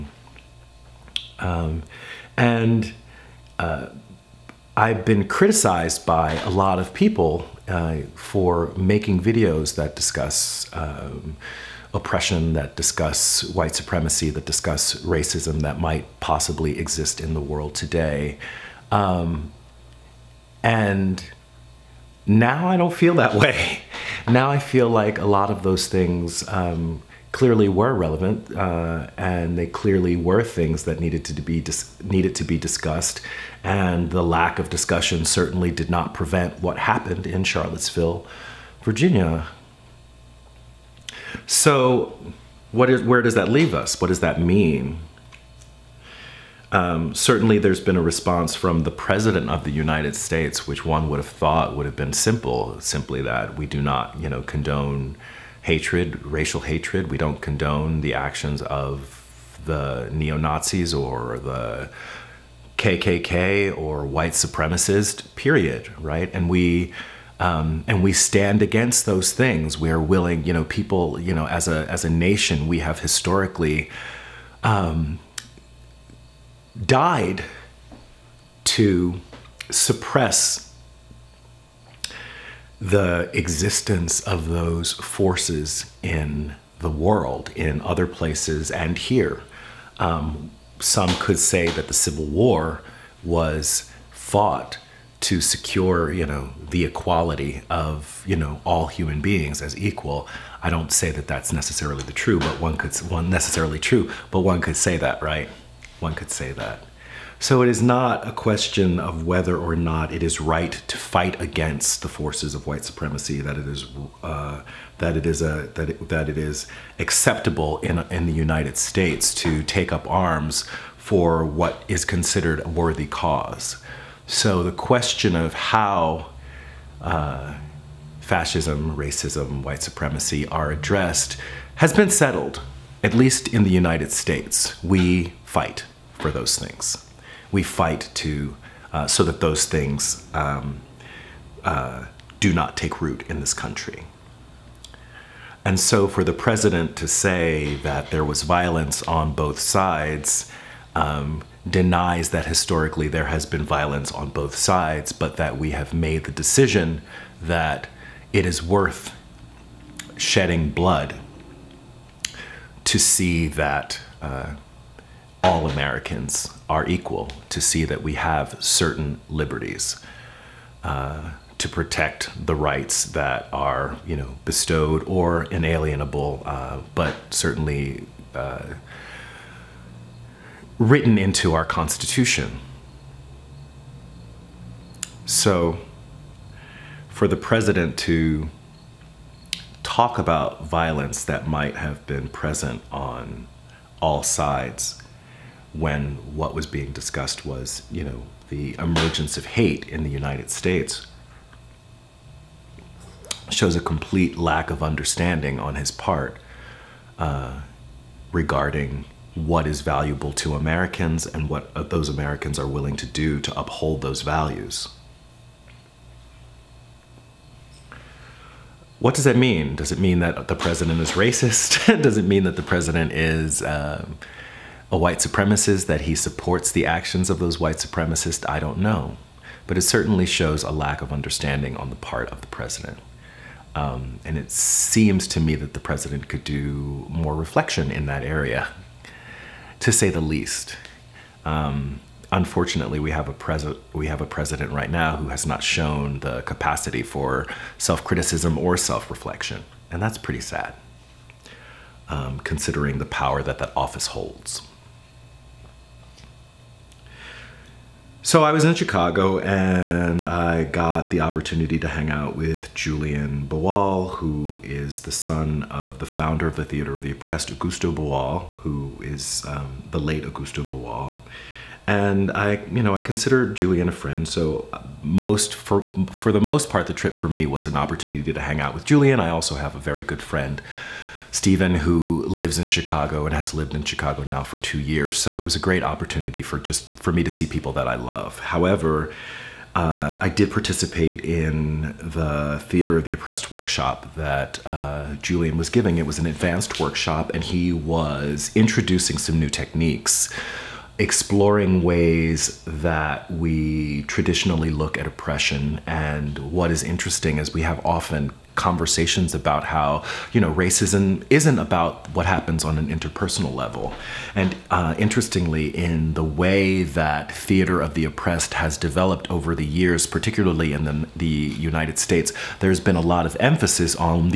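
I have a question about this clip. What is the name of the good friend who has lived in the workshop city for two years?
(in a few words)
Stephen.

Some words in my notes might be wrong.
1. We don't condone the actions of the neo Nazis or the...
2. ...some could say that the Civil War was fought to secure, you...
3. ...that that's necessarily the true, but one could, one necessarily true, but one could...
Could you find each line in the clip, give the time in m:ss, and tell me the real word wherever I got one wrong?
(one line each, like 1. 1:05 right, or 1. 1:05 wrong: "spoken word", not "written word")
1. 0:57 right
2. 1:30 right
3. 1:41 right.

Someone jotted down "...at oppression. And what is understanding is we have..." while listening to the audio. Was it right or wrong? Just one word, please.
wrong.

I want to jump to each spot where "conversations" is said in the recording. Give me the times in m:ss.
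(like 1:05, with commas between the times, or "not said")
5:08.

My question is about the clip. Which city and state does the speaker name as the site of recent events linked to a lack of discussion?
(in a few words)
Charlottesville, Virginia.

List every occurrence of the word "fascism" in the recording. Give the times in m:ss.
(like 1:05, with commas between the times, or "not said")
2:08.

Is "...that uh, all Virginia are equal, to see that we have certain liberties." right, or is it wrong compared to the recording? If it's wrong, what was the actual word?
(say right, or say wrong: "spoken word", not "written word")
wrong: "Americans", not "Virginia".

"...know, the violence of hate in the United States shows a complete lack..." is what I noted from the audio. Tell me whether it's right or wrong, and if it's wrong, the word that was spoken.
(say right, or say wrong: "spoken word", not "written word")
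wrong: "emergence", not "violence".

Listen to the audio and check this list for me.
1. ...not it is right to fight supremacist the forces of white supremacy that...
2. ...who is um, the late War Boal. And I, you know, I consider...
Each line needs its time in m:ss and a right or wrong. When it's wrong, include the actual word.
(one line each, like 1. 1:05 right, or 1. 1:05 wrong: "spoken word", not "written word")
1. 1:49 wrong: "against", not "supremacist"
2. 4:28 wrong: "Augusto", not "War".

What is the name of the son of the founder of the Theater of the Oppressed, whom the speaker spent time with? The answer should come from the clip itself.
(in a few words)
Julian Boal.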